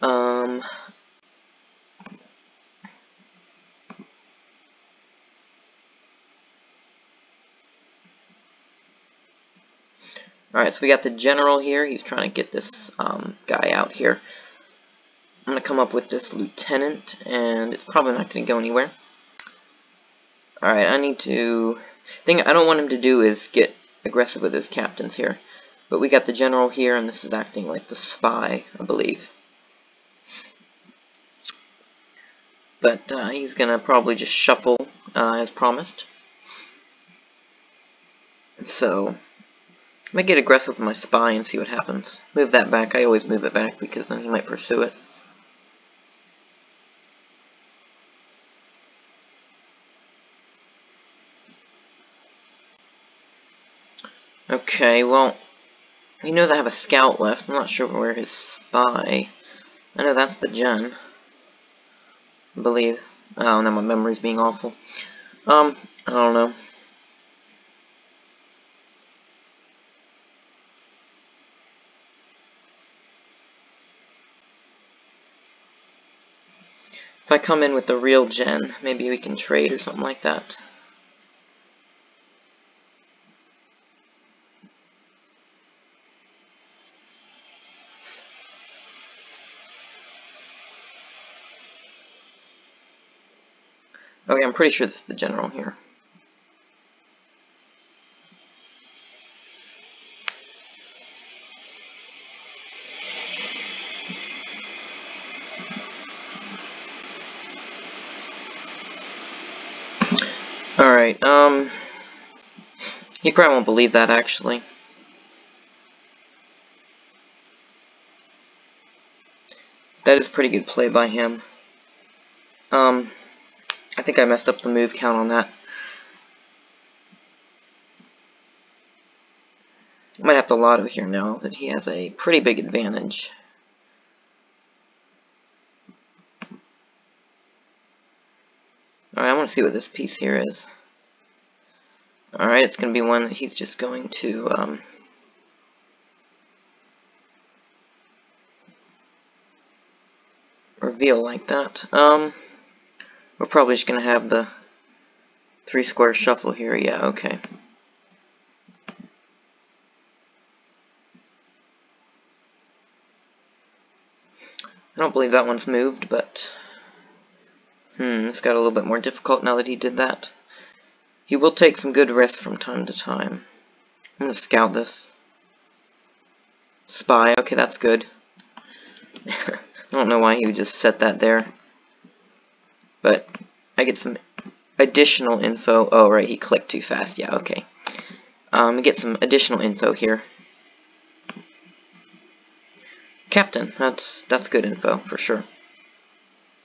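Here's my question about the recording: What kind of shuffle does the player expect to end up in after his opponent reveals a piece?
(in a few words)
three square.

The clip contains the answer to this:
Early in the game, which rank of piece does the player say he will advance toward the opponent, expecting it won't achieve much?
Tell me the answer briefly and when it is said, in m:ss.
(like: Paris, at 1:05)
lieutenant, at 0:16.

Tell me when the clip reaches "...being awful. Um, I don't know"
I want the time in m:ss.
1:04.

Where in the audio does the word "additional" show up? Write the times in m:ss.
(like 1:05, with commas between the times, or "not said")
3:04, 3:09.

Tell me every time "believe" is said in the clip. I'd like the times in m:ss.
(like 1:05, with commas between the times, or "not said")
0:28, 1:02, 1:53, 2:45.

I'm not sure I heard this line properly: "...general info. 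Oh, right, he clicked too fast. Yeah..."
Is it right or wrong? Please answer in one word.
wrong.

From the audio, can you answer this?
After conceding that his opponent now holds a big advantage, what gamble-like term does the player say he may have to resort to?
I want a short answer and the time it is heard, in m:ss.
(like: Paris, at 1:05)
Lotto, at 2:10.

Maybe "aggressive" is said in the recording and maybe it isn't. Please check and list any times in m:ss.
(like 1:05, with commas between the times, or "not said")
0:24, 0:40.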